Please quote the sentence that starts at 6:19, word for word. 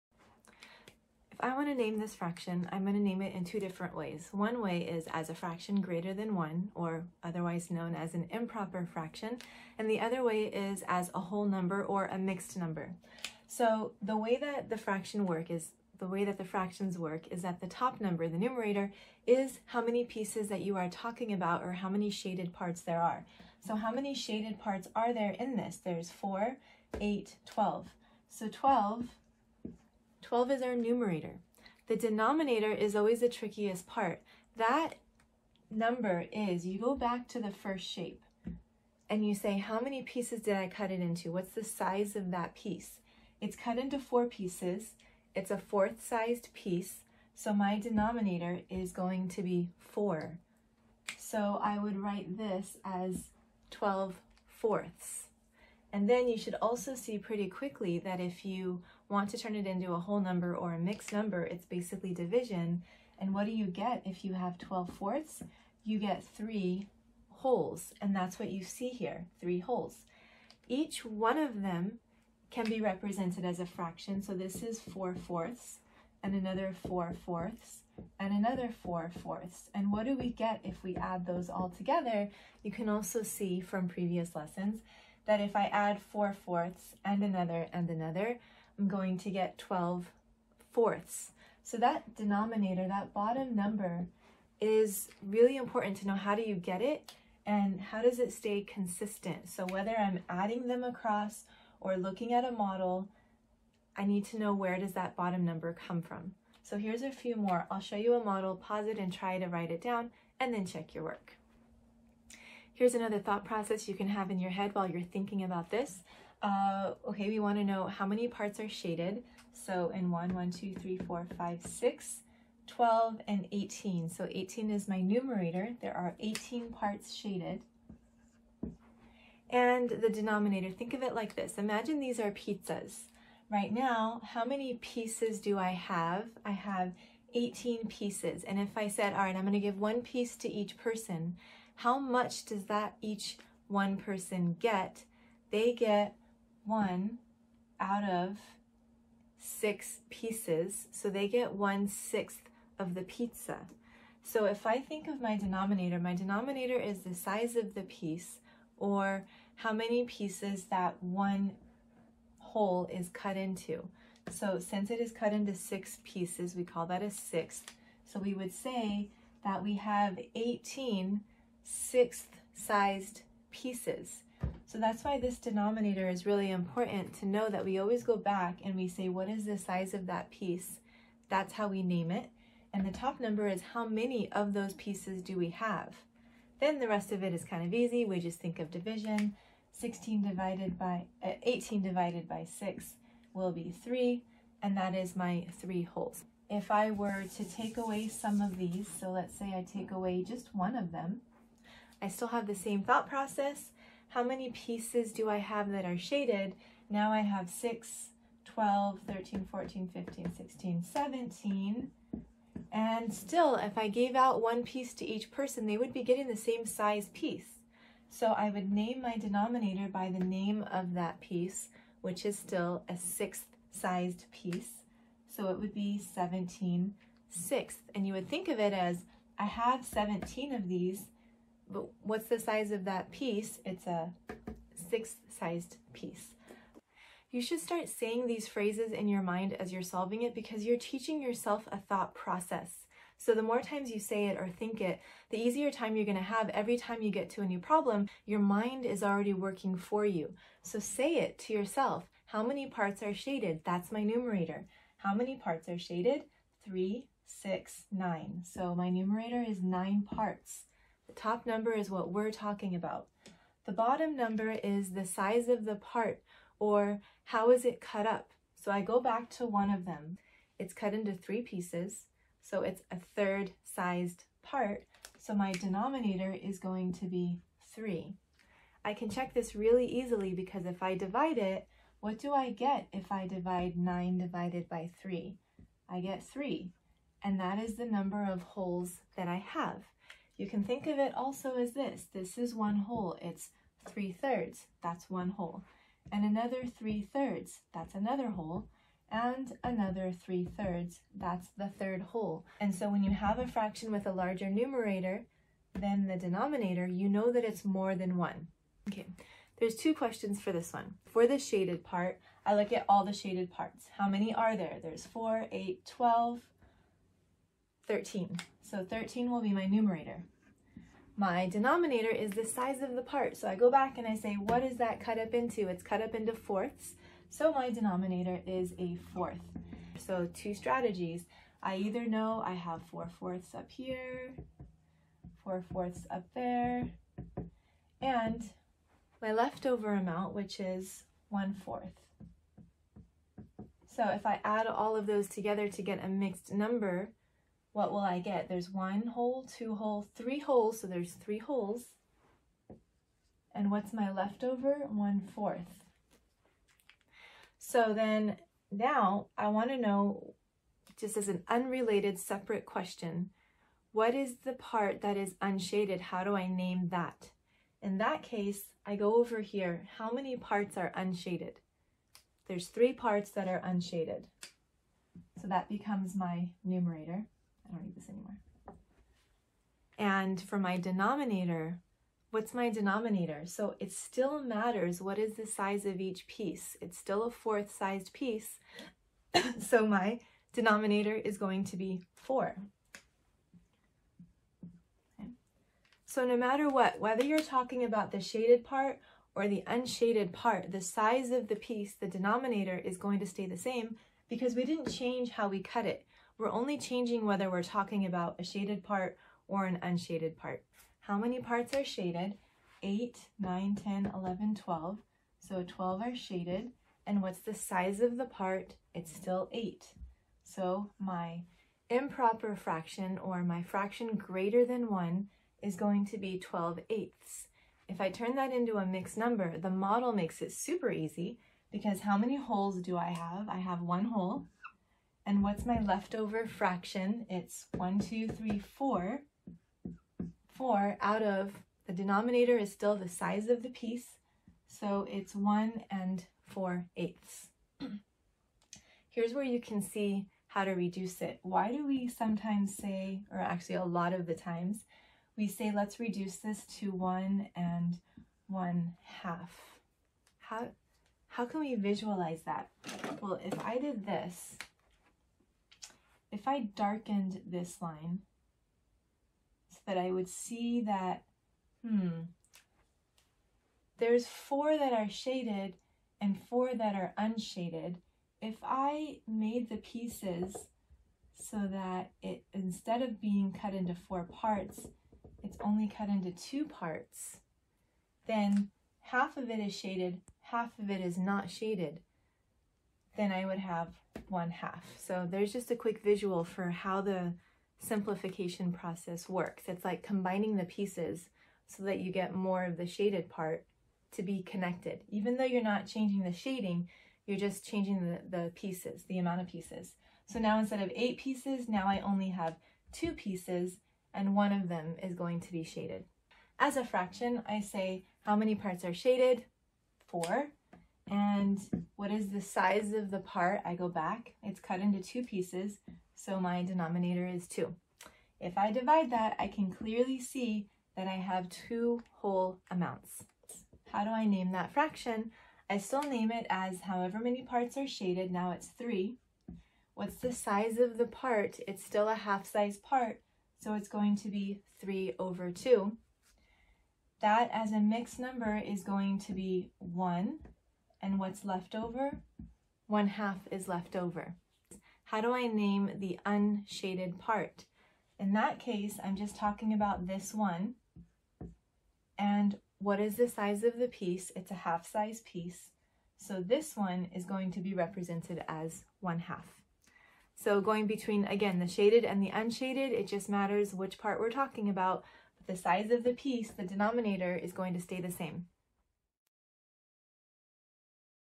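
And for my denominator, what's my denominator?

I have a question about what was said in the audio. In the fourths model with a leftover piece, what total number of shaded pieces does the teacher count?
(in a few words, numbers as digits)
13.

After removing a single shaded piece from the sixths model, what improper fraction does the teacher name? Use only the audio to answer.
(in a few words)
17 sixths.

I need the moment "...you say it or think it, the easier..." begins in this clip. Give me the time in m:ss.
4:03.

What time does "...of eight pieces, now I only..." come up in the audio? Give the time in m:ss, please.
8:30.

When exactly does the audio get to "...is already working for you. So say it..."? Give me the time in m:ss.
4:08.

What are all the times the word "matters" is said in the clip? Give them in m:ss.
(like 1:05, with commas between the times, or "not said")
6:24, 6:36, 9:33.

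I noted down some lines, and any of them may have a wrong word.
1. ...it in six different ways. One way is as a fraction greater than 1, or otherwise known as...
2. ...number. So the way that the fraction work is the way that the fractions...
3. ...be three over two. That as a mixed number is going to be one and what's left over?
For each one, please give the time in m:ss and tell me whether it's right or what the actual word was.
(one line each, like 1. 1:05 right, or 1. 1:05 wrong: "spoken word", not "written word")
1. 0:03 wrong: "two", not "six"
2. 0:12 right
3. 9:04 right.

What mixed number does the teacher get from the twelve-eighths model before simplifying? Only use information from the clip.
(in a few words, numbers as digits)
1 and 4/8.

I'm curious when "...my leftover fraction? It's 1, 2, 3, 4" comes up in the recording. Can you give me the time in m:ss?
7:15.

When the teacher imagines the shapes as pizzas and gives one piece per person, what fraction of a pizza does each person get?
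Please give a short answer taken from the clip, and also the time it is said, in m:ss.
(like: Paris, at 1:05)
One sixth, at 2:31.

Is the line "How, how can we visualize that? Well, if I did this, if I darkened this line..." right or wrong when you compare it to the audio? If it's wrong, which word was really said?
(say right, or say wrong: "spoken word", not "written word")
right.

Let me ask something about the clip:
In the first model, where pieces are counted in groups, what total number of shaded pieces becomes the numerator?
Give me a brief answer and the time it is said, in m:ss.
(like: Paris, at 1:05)
12, at 0:28.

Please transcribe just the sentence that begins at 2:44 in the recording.
So since it is cut into six pieces, we call that a sixth.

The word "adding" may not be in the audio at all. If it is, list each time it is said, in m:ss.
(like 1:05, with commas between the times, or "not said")
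1:40.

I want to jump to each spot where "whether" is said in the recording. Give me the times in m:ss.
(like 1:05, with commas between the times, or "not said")
1:39, 6:36, 6:47.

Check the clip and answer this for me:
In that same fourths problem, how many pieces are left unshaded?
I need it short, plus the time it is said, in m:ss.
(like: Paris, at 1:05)
3, at 6:12.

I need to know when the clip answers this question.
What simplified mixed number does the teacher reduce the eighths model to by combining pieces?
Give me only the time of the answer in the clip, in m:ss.
7:36.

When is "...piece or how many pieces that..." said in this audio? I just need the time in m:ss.
2:37.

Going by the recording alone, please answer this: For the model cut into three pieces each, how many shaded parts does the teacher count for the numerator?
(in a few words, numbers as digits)
9.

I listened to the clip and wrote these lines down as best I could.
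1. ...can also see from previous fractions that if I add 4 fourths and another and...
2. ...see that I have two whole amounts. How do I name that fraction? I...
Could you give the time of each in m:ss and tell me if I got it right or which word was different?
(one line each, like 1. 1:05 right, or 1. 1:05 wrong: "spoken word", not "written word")
1. 1:22 wrong: "lessons", not "fractions"
2. 8:50 right.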